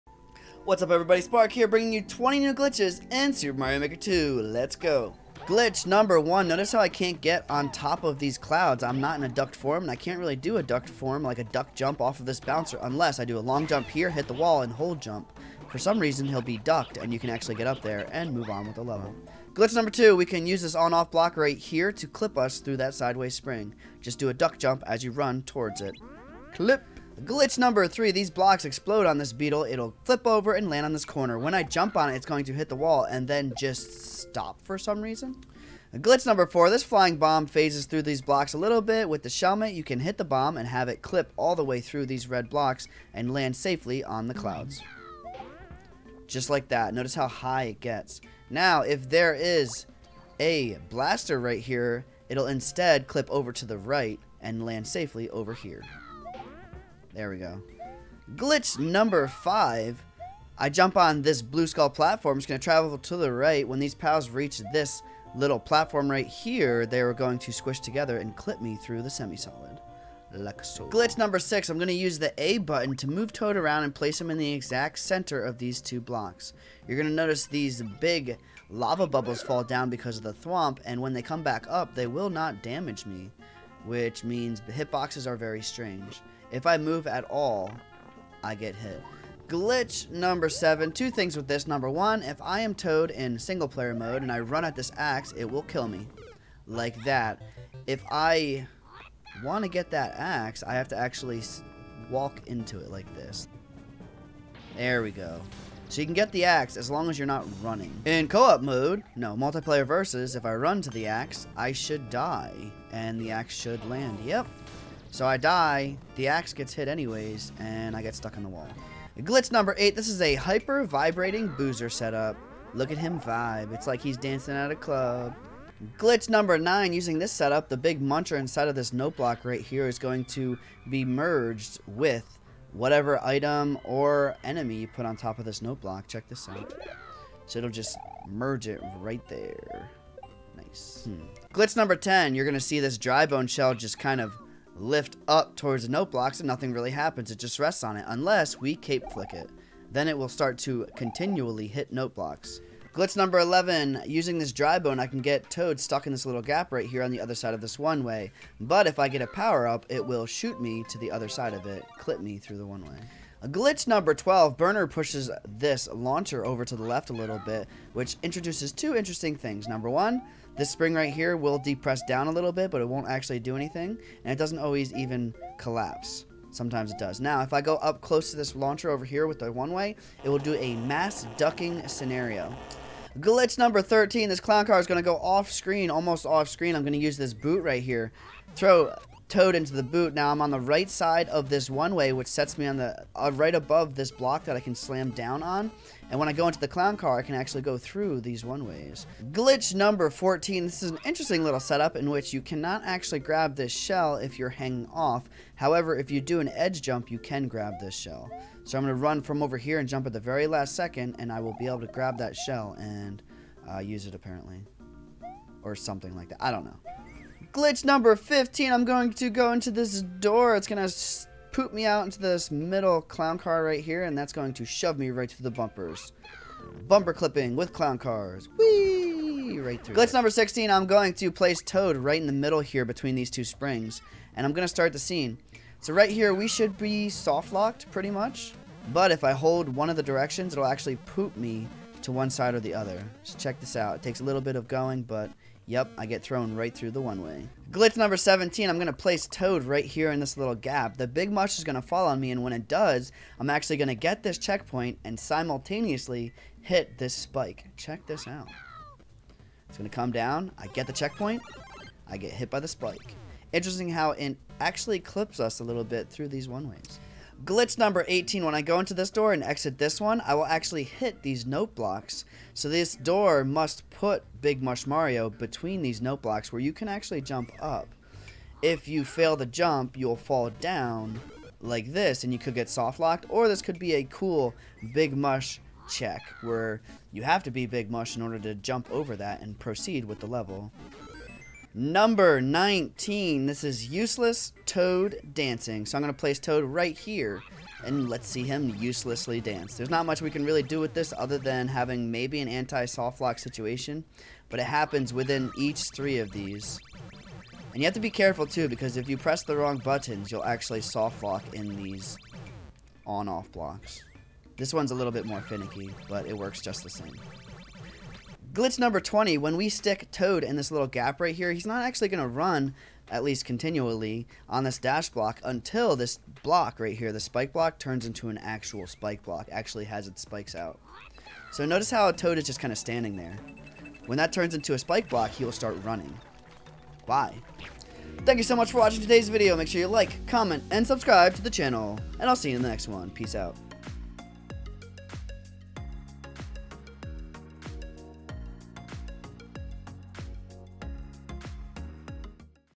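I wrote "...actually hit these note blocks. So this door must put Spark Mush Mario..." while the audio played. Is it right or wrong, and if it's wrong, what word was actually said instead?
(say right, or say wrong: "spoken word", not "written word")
wrong: "Big", not "Spark".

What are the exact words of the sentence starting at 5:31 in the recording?
So notice how Toad is just kind of standing there.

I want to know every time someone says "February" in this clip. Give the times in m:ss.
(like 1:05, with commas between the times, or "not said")
not said.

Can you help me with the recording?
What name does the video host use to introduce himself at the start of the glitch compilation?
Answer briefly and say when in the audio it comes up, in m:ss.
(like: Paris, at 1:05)
Spark, at 0:01.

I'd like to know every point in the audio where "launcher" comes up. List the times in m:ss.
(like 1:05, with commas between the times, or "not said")
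2:45, 2:58.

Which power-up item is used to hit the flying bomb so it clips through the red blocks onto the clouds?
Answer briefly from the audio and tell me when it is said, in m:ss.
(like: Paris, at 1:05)
shelmet, at 0:39.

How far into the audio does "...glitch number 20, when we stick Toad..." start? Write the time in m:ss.
5:18.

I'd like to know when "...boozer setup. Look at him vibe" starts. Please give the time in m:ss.
2:01.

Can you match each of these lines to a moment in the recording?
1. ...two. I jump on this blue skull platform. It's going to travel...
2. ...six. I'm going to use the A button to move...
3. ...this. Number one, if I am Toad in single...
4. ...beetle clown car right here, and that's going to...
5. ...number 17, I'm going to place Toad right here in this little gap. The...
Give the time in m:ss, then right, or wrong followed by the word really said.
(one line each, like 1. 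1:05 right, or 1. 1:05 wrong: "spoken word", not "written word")
1. 0:59 wrong: "five", not "two"
2. 1:11 right
3. 1:31 right
4. 3:42 wrong: "middle", not "beetle"
5. 4:07 right.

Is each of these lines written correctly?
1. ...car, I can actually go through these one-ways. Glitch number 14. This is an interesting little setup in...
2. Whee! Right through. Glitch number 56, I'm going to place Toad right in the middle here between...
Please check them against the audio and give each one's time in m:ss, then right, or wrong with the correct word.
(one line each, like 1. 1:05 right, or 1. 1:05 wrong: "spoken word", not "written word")
1. 3:16 right
2. 3:48 wrong: "16", not "56".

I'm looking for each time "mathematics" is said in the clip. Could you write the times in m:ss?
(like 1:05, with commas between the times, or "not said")
not said.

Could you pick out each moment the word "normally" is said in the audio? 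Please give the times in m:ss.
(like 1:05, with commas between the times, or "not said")
not said.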